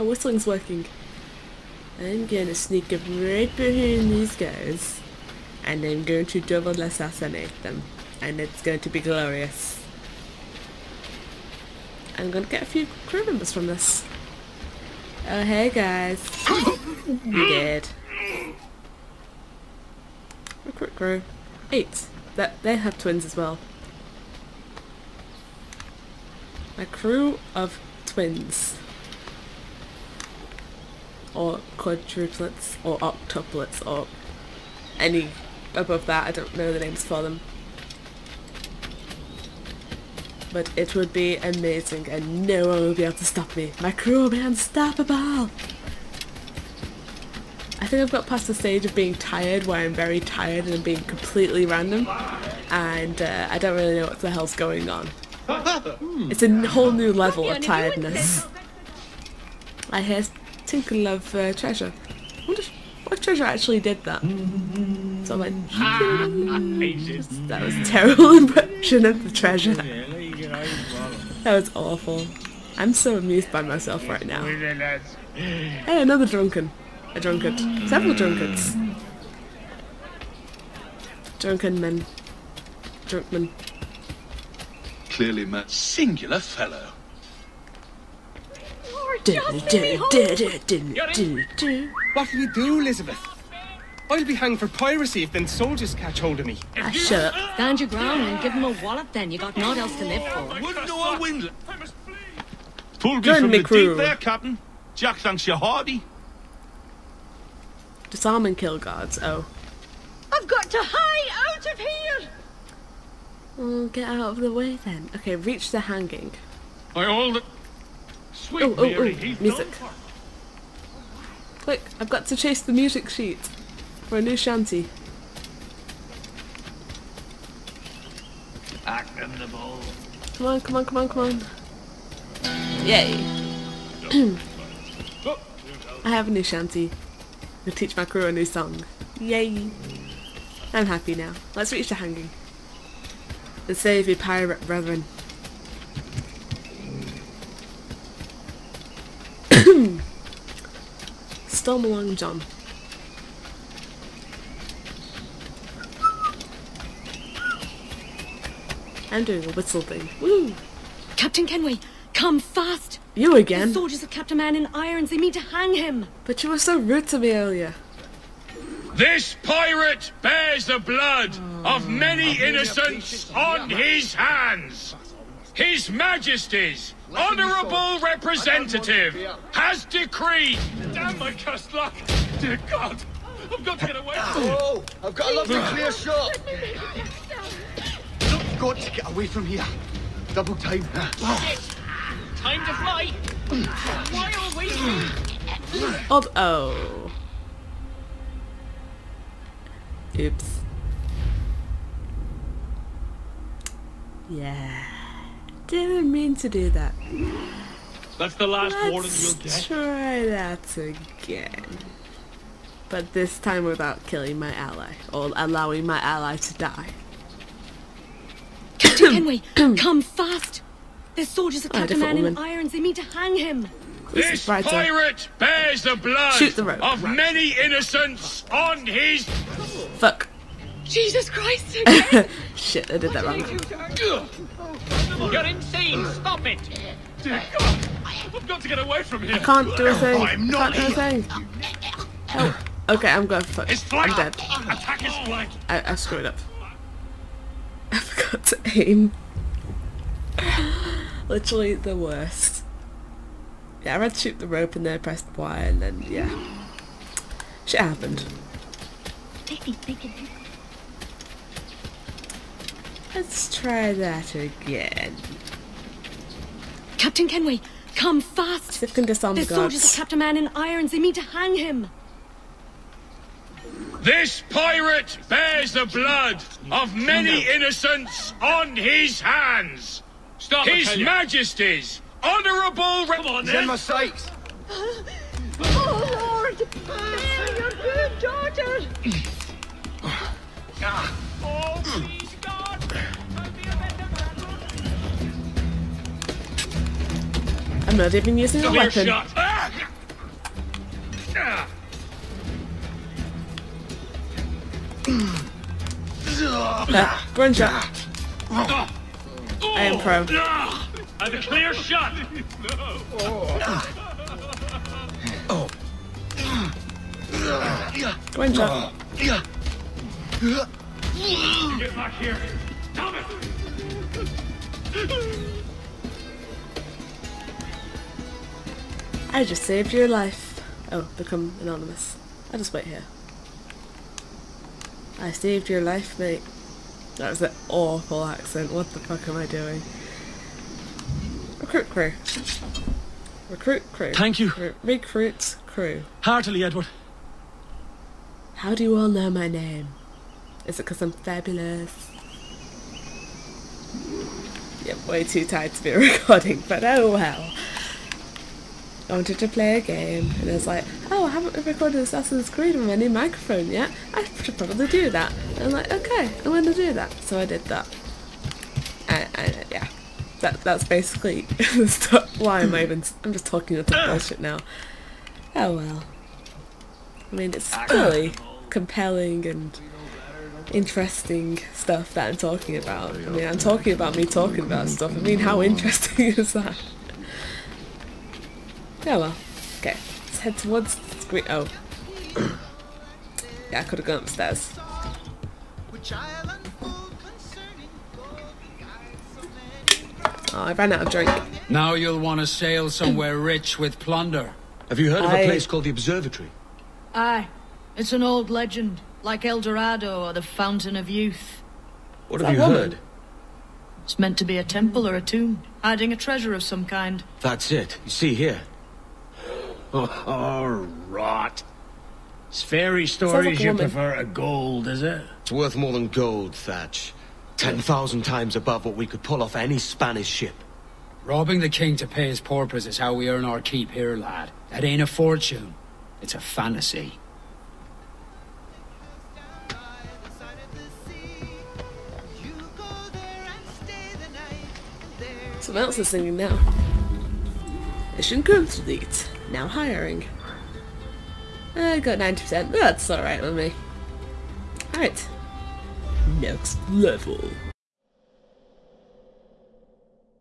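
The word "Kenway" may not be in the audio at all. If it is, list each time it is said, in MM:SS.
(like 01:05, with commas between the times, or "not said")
02:41, 04:27.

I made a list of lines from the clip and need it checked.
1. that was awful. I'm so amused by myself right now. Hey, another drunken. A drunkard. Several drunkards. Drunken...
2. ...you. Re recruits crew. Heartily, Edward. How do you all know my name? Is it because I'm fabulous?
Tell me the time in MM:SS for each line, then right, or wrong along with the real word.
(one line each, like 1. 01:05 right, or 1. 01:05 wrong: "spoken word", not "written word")
1. 01:09 right
2. 05:44 right.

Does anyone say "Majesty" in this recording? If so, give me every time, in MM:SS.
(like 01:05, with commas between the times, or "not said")
02:55, 04:40.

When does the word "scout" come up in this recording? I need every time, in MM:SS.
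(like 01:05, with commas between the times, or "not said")
not said.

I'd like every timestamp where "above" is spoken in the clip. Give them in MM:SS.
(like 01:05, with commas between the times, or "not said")
00:35, 07:08.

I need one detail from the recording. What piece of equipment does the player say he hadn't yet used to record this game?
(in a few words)
New microphone.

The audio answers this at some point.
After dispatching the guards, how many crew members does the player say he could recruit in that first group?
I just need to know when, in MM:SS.
00:21.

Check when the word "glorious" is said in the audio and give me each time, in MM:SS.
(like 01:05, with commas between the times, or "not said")
00:08.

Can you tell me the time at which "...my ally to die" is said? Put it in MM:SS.
03:35.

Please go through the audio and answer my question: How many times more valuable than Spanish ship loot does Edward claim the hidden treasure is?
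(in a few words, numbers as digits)
10000.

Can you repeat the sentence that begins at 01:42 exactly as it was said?
Pull me from the deep there, Captain.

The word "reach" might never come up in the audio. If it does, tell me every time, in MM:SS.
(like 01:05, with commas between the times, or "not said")
01:55, 02:21.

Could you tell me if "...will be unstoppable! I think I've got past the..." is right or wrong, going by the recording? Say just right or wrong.
right.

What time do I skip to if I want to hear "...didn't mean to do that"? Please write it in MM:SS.
03:25.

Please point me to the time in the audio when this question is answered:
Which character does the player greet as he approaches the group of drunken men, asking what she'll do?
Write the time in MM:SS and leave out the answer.
01:32.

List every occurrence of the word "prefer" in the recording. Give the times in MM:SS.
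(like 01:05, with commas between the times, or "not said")
07:03.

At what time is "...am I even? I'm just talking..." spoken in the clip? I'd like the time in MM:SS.
06:12.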